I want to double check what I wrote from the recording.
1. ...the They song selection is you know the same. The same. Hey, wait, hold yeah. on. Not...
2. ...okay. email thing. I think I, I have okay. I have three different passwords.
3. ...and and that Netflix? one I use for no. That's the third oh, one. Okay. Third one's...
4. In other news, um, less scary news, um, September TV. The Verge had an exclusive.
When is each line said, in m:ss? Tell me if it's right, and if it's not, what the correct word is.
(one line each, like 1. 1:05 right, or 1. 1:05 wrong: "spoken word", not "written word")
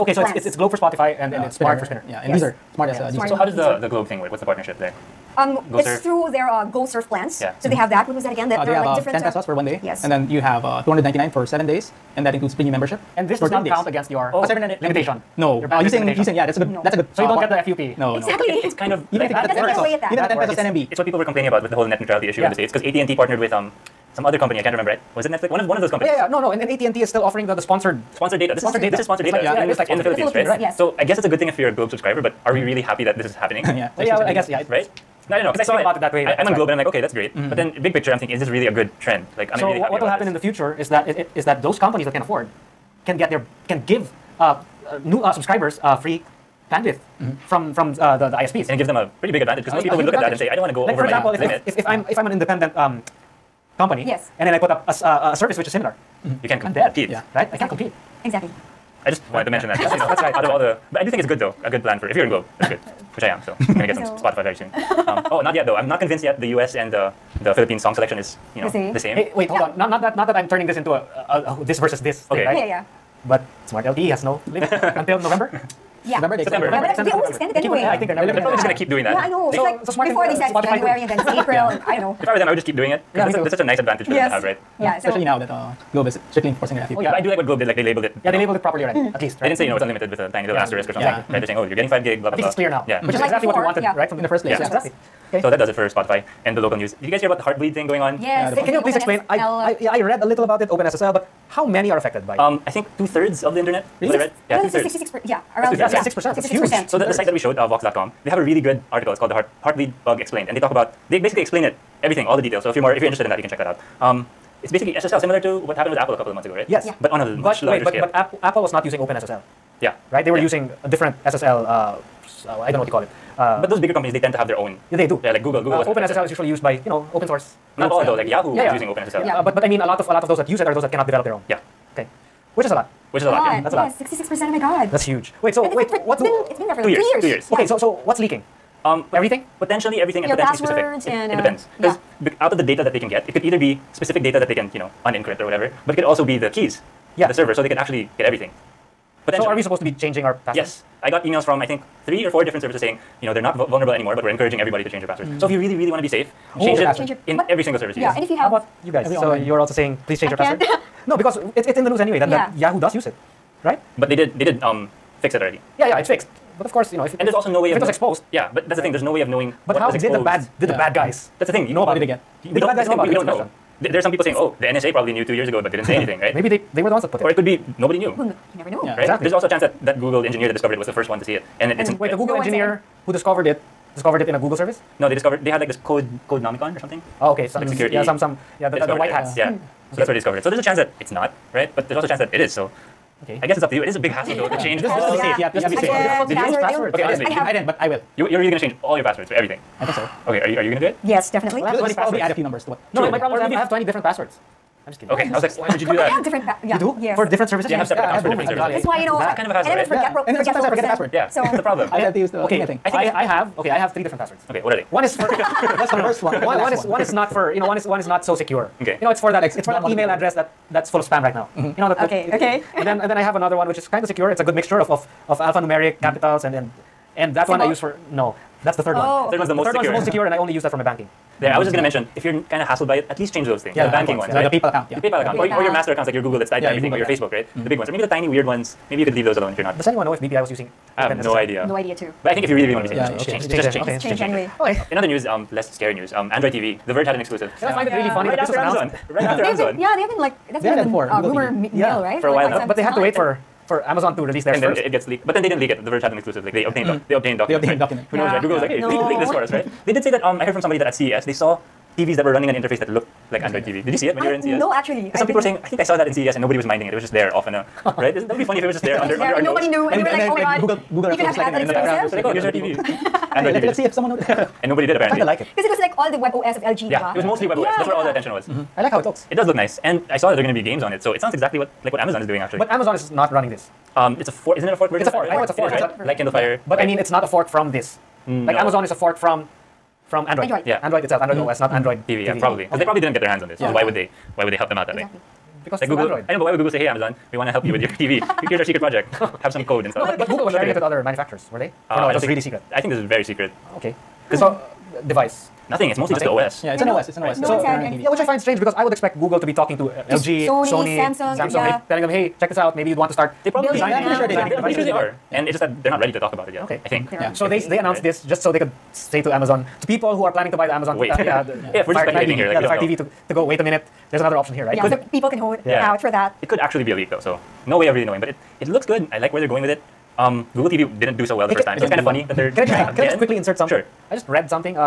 1. 1:07 wrong: "Philippine", not "They"
2. 3:32 right
3. 3:46 wrong: "Symbol", not "Netflix"
4. 4:04 wrong: "Android", not "September".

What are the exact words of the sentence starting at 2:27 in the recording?
the server, so they could actually get everything.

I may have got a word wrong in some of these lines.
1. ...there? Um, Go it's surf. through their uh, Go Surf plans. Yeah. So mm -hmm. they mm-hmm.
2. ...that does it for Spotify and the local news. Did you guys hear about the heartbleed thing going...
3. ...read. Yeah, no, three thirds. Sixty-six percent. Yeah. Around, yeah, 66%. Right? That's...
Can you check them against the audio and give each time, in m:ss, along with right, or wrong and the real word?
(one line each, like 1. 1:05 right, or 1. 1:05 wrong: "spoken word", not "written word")
1. 0:04 right
2. 1:35 right
3. 1:44 wrong: "two", not "three".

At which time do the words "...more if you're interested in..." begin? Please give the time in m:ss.
1:52.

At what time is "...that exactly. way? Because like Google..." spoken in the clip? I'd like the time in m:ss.
4:54.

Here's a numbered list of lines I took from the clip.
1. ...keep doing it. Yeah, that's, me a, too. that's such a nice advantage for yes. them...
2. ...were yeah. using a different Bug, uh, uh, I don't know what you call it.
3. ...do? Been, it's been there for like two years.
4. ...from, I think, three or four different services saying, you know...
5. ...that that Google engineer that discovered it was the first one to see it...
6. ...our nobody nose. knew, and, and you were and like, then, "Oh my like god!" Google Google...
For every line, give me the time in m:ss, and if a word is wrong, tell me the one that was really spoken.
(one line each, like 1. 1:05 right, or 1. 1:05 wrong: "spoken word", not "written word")
1. 1:22 right
2. 2:00 wrong: "SSL", not "Bug"
3. 2:16 right
4. 2:31 right
5. 2:59 right
6. 4:29 right.